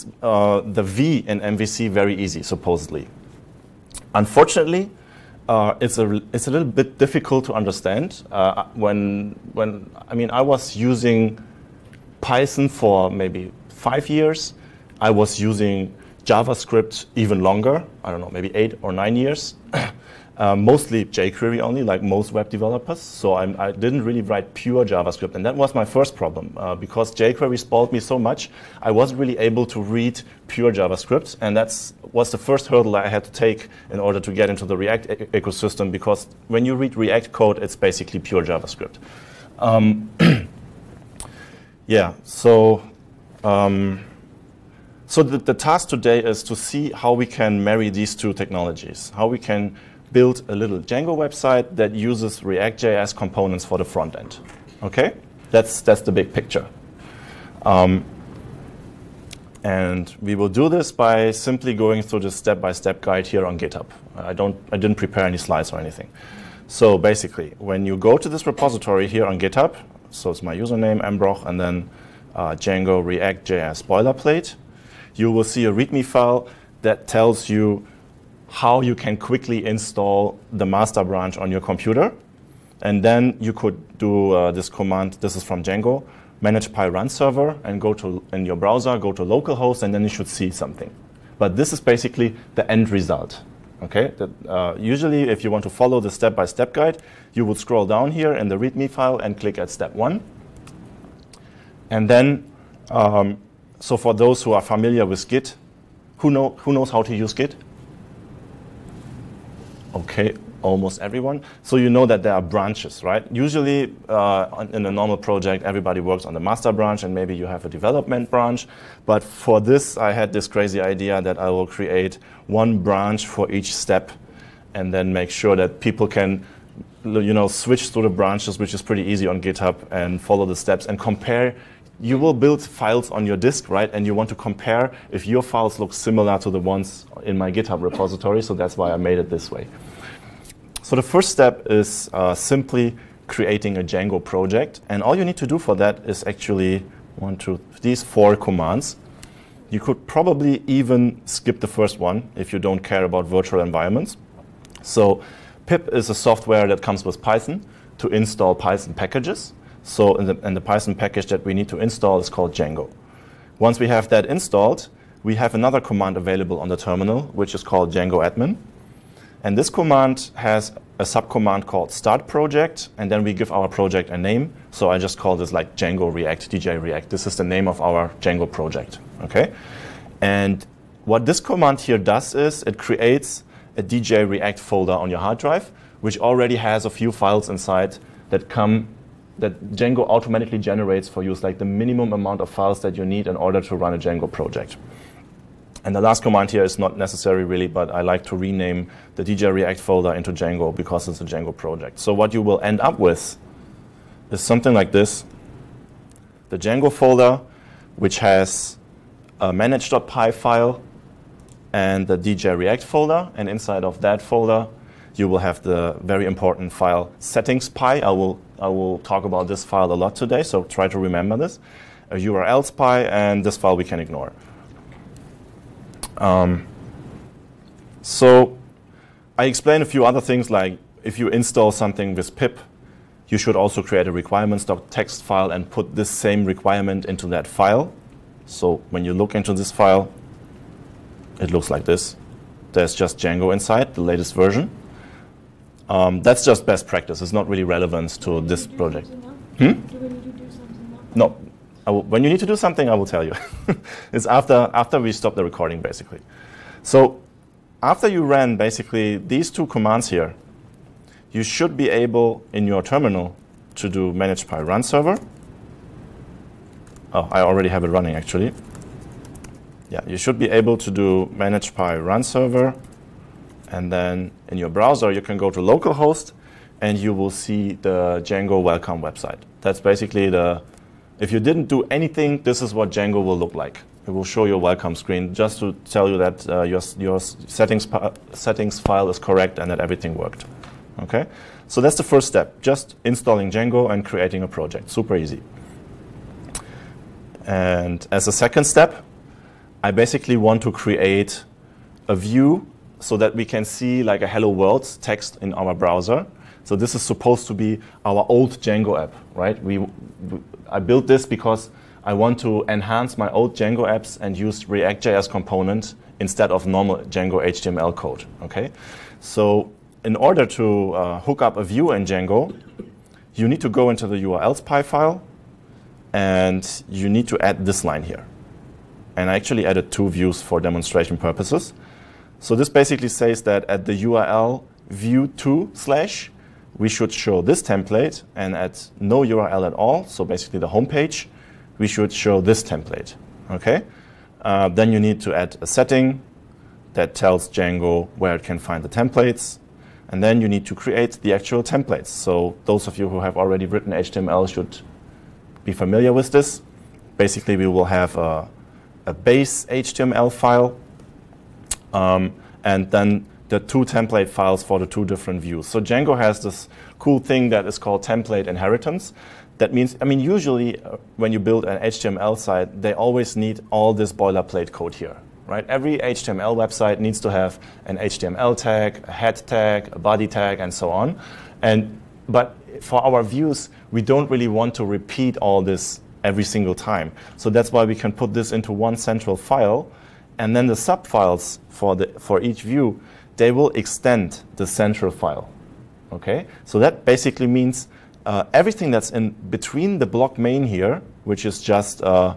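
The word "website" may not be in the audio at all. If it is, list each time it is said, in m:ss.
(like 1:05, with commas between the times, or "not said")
0:51, 4:39, 6:16.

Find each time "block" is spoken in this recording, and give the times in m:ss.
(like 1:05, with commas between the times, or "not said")
6:40.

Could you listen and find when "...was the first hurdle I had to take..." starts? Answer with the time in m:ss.
0:32.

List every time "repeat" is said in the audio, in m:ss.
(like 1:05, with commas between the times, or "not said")
6:24.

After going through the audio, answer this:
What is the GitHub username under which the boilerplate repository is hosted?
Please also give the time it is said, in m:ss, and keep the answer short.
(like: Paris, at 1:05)
mbrochh, at 1:11.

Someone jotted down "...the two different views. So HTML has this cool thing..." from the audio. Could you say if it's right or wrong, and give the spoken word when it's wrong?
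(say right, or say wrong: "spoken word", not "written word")
wrong: "Django", not "HTML".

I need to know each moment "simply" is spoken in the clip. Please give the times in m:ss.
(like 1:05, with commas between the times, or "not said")
1:01, 2:22.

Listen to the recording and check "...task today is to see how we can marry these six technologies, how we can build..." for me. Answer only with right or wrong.
wrong.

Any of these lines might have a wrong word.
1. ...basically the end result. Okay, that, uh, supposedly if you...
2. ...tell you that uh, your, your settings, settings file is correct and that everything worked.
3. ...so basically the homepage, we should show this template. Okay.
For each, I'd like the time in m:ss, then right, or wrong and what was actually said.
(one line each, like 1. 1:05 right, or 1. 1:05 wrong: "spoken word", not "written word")
1. 1:31 wrong: "usually", not "supposedly"
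2. 4:45 right
3. 5:40 right.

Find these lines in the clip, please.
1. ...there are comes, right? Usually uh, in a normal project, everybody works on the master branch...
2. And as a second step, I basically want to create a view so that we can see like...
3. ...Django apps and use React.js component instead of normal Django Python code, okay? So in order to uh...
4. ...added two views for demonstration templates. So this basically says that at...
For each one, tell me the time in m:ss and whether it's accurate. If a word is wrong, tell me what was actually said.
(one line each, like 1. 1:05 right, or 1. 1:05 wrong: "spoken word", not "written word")
1. 1:52 wrong: "branches", not "comes"
2. 4:57 right
3. 5:13 wrong: "HTML", not "Python"
4. 5:29 wrong: "purposes", not "templates".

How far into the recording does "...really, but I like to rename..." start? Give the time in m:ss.
3:17.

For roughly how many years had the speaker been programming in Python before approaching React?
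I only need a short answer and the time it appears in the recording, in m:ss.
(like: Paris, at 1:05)
5, at 0:13.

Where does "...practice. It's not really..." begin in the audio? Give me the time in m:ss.
4:06.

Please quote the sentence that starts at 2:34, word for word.
So pip is a software that comes with Python to install Python packages.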